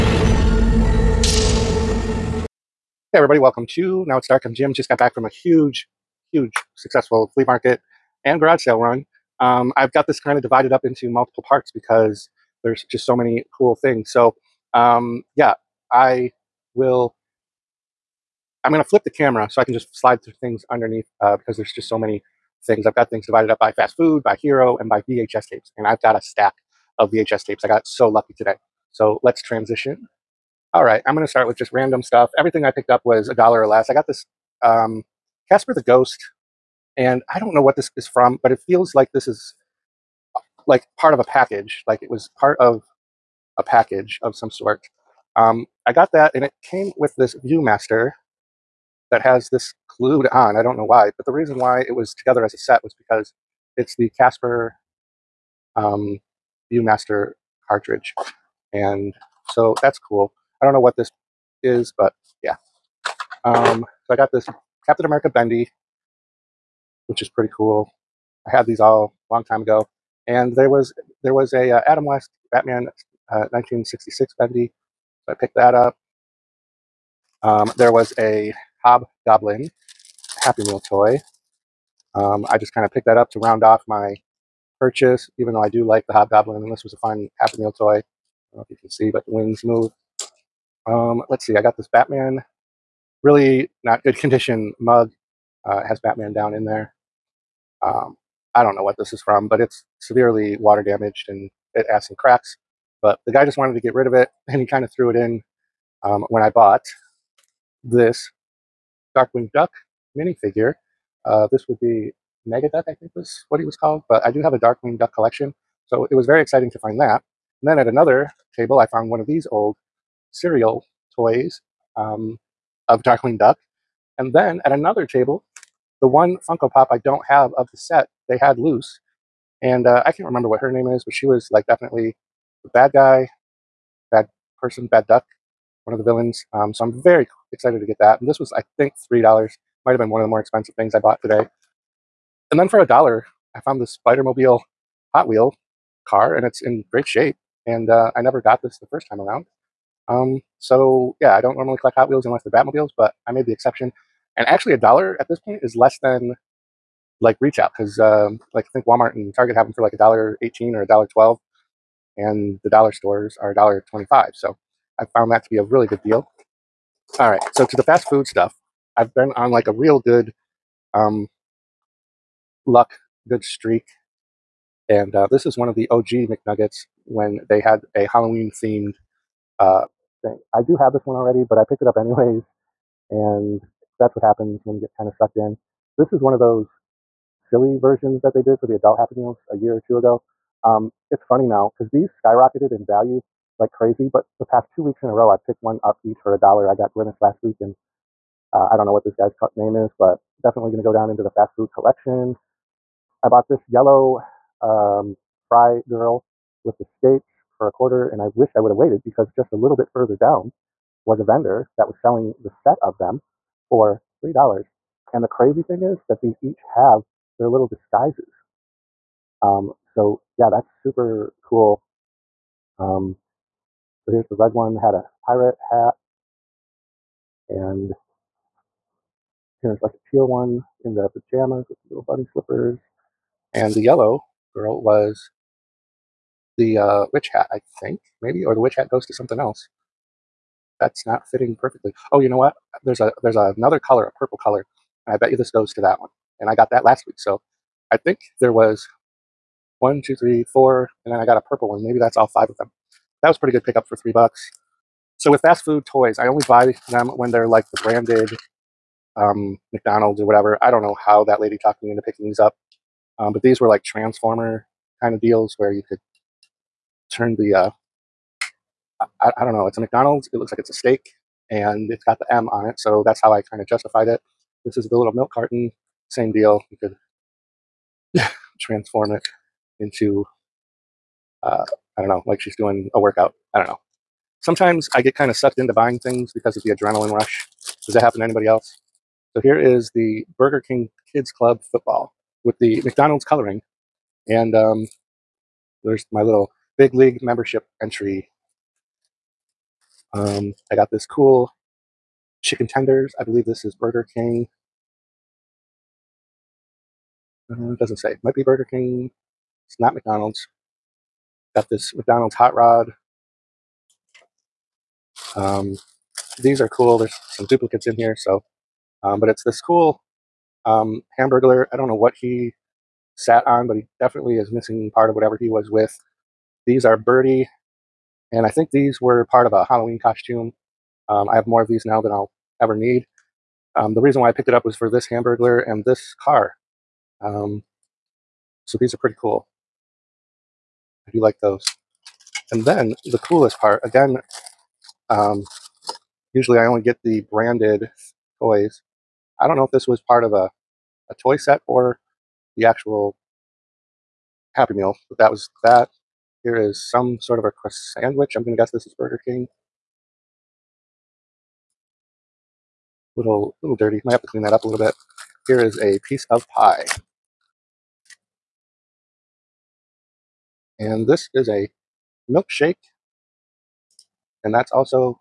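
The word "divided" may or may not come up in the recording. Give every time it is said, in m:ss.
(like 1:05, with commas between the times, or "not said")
0:10, 0:23.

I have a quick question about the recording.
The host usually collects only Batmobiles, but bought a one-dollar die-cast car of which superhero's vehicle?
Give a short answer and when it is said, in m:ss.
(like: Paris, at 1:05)
Spidermobile, at 2:24.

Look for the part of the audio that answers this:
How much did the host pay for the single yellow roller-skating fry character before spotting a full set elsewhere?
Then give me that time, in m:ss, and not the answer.
3:27.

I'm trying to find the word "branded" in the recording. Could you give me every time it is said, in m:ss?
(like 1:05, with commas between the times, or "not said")
4:17, 5:47.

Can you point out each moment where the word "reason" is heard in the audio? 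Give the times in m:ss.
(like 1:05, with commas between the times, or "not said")
0:51, 5:34.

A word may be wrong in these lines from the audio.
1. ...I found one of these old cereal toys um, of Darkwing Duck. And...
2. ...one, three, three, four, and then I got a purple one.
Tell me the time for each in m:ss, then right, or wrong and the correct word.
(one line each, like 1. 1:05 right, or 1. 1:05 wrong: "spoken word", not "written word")
1. 1:58 right
2. 4:09 wrong: "two", not "three".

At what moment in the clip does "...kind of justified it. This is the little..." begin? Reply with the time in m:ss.
4:33.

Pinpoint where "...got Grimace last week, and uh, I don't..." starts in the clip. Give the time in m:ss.
3:16.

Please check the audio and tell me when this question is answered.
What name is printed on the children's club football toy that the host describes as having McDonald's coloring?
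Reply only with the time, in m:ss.
4:50.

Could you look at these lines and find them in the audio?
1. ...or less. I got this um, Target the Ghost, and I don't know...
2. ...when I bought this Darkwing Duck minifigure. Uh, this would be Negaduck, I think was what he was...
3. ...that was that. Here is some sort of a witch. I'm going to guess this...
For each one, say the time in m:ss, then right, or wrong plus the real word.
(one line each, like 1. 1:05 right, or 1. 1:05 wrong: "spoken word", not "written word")
1. 0:33 wrong: "Casper", not "Target"
2. 1:46 right
3. 5:55 wrong: "sandwich", not "witch".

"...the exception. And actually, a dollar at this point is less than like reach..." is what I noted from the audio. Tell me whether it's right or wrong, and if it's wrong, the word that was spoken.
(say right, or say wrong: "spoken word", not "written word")
right.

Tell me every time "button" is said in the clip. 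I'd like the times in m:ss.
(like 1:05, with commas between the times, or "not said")
not said.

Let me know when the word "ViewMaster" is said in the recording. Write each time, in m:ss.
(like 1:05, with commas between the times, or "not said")
0:47, 0:56.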